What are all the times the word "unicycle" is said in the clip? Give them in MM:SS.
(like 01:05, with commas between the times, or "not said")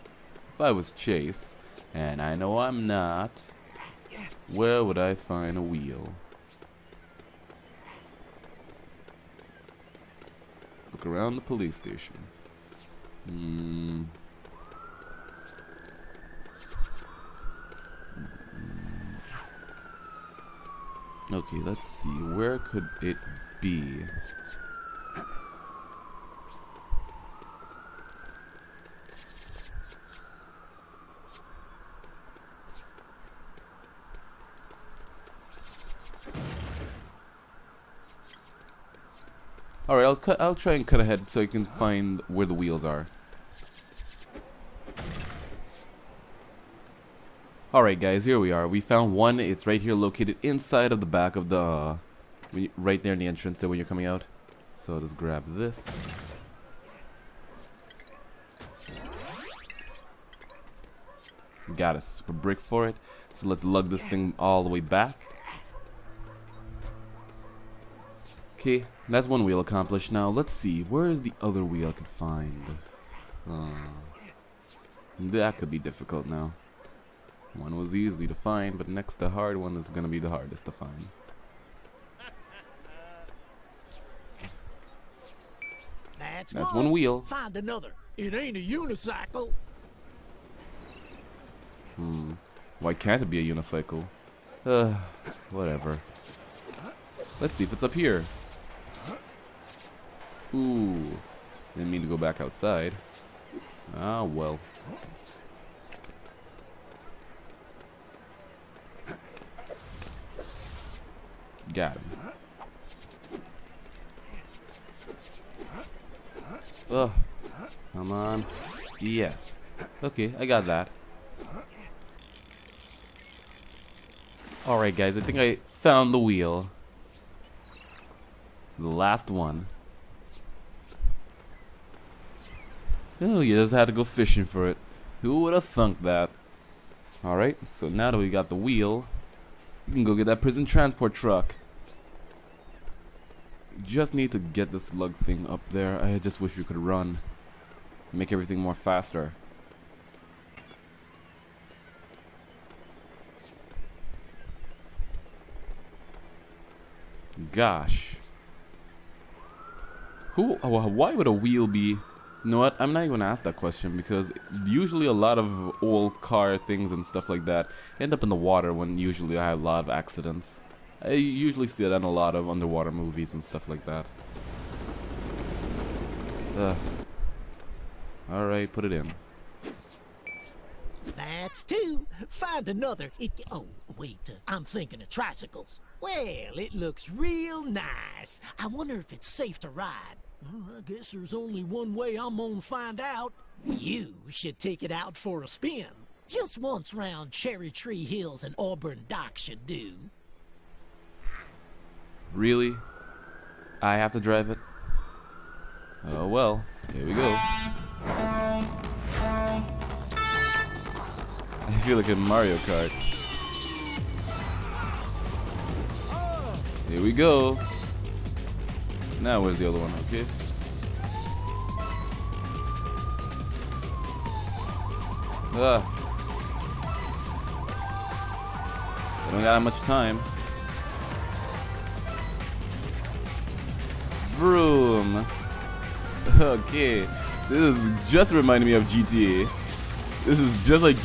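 01:28, 01:33.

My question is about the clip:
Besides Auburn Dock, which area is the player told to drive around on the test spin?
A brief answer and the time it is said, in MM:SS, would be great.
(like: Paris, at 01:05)
Cherry Tree Hills, at 03:17.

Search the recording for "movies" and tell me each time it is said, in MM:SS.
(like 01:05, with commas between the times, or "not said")
02:52.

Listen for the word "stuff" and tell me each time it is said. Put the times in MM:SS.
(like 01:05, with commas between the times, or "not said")
02:47, 02:53.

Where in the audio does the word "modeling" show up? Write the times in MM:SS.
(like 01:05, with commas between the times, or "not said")
not said.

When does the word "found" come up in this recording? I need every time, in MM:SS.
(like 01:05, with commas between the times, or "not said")
00:48, 02:05.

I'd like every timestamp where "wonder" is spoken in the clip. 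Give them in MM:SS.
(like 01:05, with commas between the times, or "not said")
03:08.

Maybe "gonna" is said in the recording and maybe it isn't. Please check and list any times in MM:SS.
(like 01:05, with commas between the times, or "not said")
02:43, 03:12.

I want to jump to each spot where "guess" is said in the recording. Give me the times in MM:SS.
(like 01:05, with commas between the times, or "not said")
03:10.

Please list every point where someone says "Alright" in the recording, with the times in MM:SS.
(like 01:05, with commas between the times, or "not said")
00:47, 02:04, 02:17, 02:58.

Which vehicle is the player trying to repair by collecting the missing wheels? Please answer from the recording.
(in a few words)
prison transport truck.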